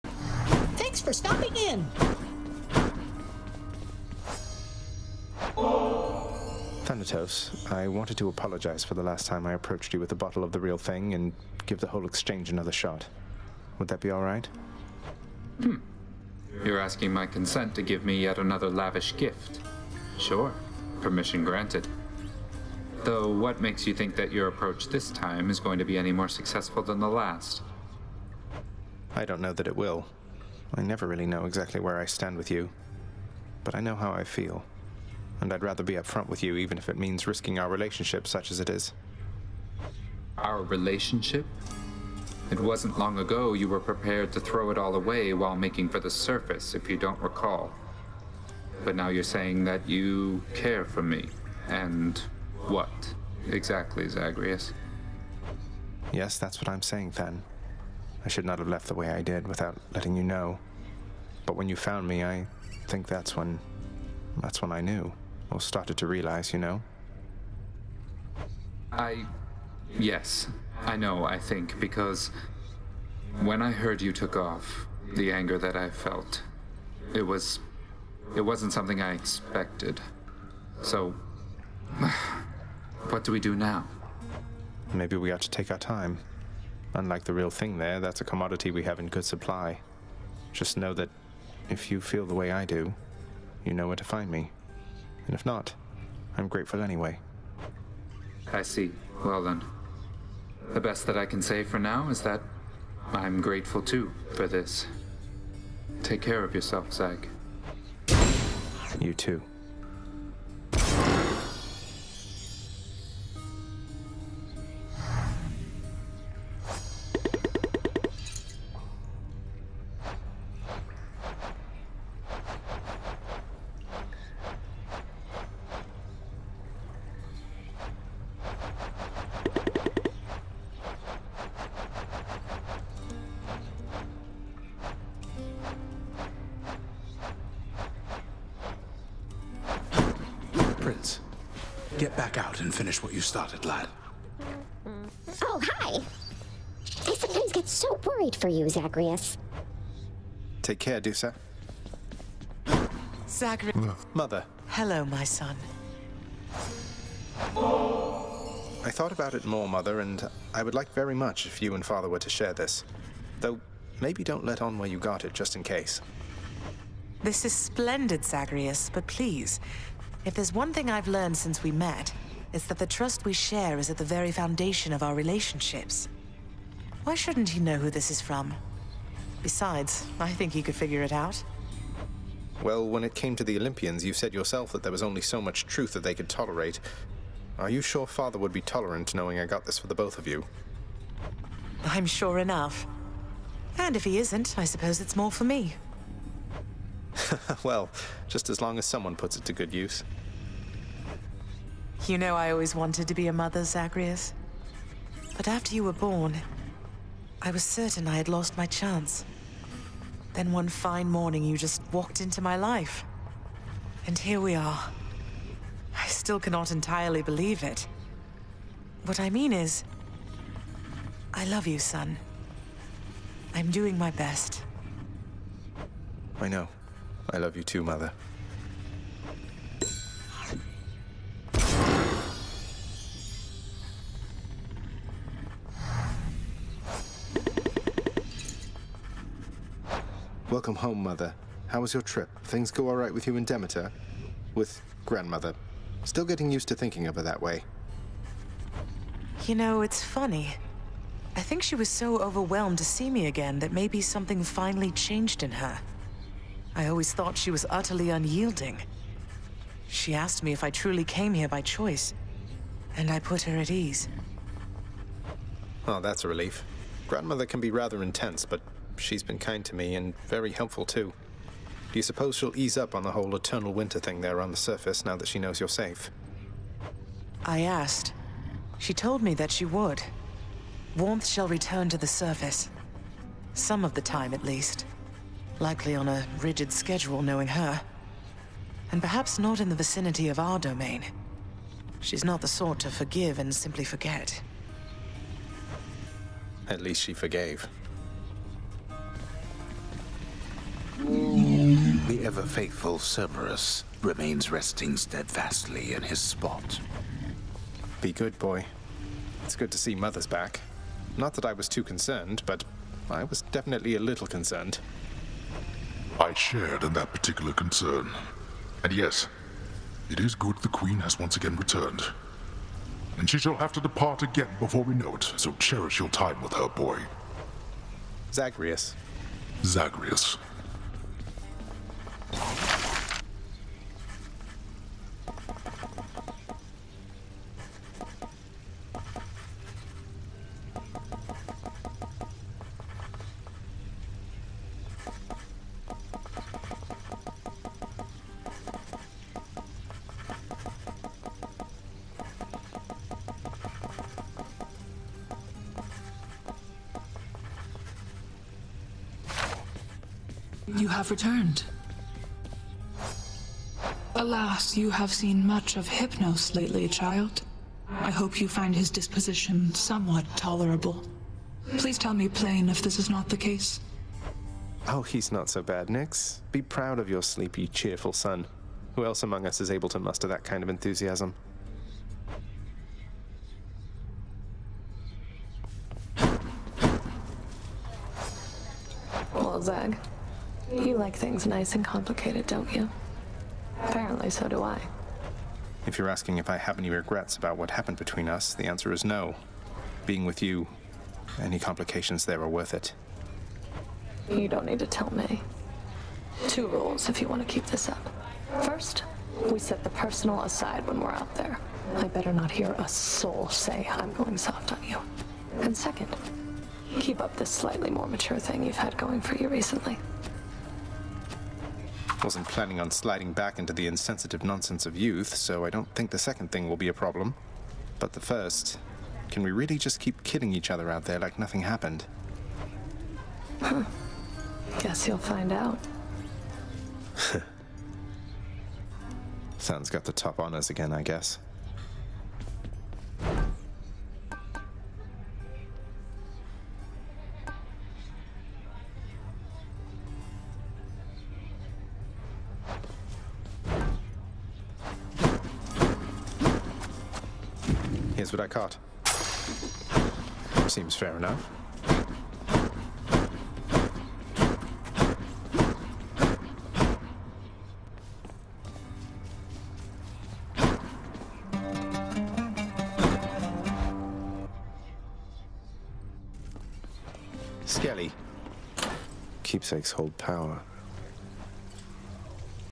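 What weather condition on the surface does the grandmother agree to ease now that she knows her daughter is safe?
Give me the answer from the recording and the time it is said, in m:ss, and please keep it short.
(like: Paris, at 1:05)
Eternal winter, at 4:33.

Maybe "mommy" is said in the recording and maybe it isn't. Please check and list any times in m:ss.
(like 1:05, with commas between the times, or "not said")
not said.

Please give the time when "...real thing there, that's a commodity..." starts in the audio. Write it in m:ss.
1:27.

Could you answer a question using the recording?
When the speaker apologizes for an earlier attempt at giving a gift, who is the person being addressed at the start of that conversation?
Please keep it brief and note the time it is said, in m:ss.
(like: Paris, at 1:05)
Thanatos, at 0:06.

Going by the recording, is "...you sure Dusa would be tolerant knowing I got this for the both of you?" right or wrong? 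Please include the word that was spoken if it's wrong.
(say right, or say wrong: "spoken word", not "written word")
wrong: "Father", not "Dusa".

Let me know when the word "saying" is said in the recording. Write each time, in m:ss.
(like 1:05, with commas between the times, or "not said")
0:49, 0:56.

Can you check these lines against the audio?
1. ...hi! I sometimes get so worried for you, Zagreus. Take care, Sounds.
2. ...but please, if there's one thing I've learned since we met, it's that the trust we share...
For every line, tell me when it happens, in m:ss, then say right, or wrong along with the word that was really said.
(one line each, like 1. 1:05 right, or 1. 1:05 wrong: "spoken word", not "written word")
1. 2:25 wrong: "Dusa", not "Sounds"
2. 2:48 right.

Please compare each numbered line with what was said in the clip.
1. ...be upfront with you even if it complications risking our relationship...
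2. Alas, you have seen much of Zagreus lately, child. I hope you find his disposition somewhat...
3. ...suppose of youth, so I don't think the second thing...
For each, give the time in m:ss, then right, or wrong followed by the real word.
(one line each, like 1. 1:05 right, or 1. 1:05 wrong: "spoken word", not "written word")
1. 0:35 wrong: "means", not "complications"
2. 6:04 wrong: "Hypnos", not "Zagreus"
3. 7:04 wrong: "nonsense", not "suppose".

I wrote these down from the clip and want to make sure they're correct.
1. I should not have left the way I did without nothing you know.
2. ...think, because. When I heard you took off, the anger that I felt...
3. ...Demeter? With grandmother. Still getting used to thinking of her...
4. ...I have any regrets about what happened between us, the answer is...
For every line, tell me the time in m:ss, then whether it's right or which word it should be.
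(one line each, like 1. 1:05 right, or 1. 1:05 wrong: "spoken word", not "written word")
1. 0:58 wrong: "letting", not "nothing"
2. 1:11 right
3. 4:03 right
4. 6:36 right.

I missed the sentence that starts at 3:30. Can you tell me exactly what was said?
Then one fine morning, you just walked into my life.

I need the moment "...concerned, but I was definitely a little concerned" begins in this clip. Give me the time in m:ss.
5:11.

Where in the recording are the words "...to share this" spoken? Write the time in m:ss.
2:42.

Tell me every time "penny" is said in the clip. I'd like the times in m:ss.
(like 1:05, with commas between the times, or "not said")
not said.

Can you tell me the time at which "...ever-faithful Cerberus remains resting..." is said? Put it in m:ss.
5:02.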